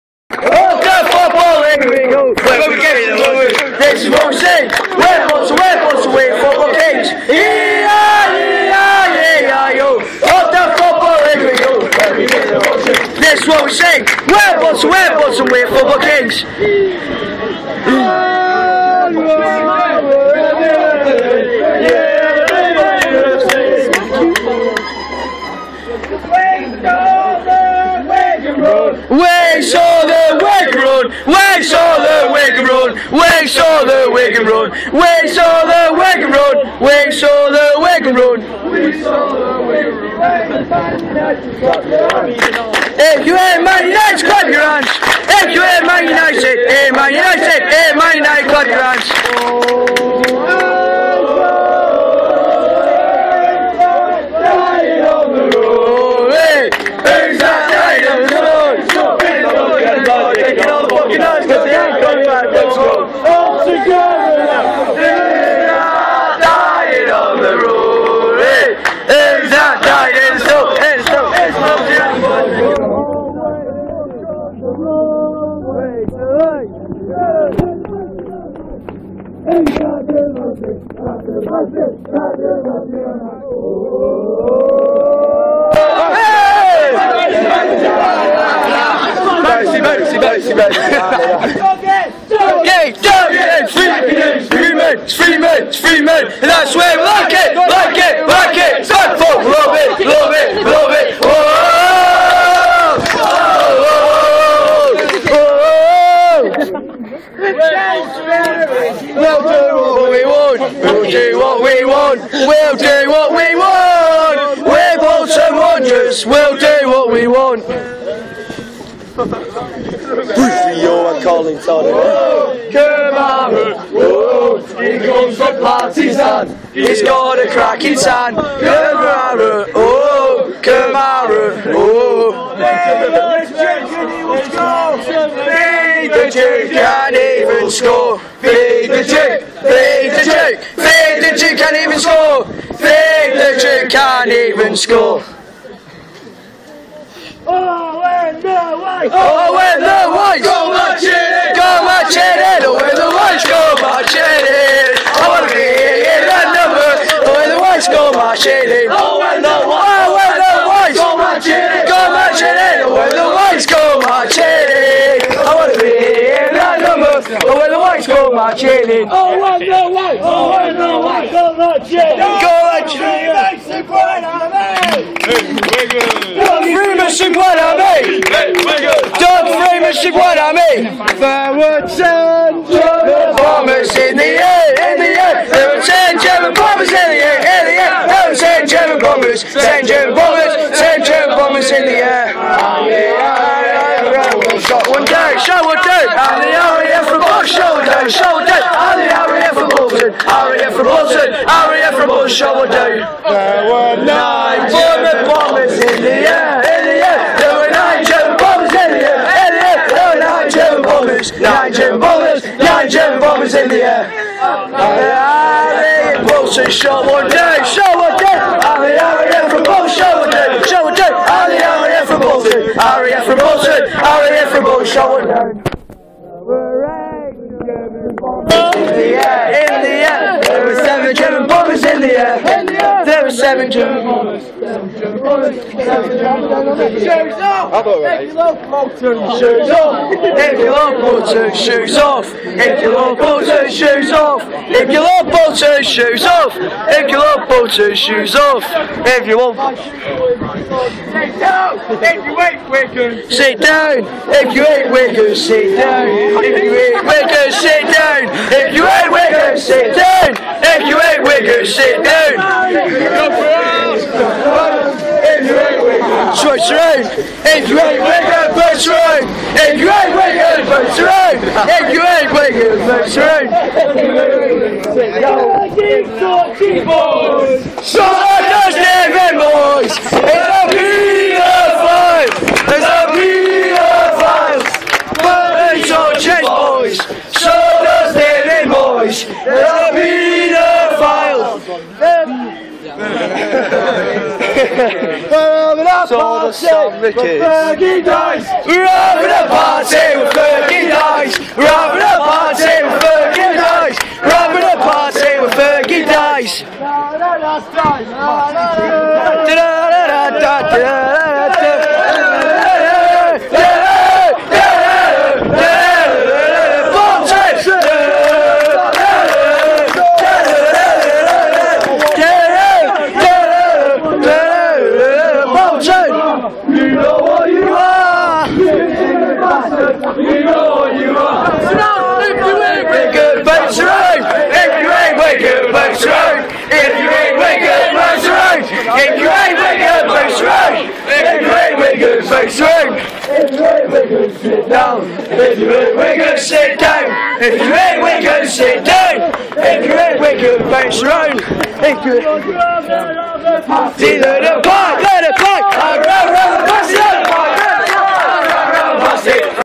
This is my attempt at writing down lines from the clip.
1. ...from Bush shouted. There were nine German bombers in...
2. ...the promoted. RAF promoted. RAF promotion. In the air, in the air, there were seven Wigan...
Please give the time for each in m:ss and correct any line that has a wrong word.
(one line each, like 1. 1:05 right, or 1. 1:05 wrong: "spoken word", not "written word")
1. 3:21 right
2. 3:40 wrong: "German", not "Wigan".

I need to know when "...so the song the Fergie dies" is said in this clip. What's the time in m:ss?
4:56.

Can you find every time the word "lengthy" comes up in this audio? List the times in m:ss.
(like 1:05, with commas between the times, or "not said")
not said.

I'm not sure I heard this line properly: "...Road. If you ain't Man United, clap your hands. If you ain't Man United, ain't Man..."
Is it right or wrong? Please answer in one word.
right.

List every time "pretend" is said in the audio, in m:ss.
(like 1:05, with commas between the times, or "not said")
not said.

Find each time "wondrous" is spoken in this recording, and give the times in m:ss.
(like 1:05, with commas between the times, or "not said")
1:55.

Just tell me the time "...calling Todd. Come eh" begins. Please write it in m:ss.
2:01.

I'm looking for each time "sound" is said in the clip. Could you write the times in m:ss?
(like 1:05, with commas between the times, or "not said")
3:01.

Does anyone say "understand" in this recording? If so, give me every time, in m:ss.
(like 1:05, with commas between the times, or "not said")
4:38, 4:47.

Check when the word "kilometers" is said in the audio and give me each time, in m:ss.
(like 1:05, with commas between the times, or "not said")
not said.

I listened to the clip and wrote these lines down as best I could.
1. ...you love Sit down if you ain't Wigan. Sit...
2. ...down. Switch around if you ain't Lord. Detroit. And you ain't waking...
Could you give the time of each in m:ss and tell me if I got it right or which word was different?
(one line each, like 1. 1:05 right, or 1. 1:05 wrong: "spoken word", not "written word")
1. 4:09 right
2. 4:22 wrong: "Wigan", not "Lord".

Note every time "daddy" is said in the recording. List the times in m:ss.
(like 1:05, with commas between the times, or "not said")
not said.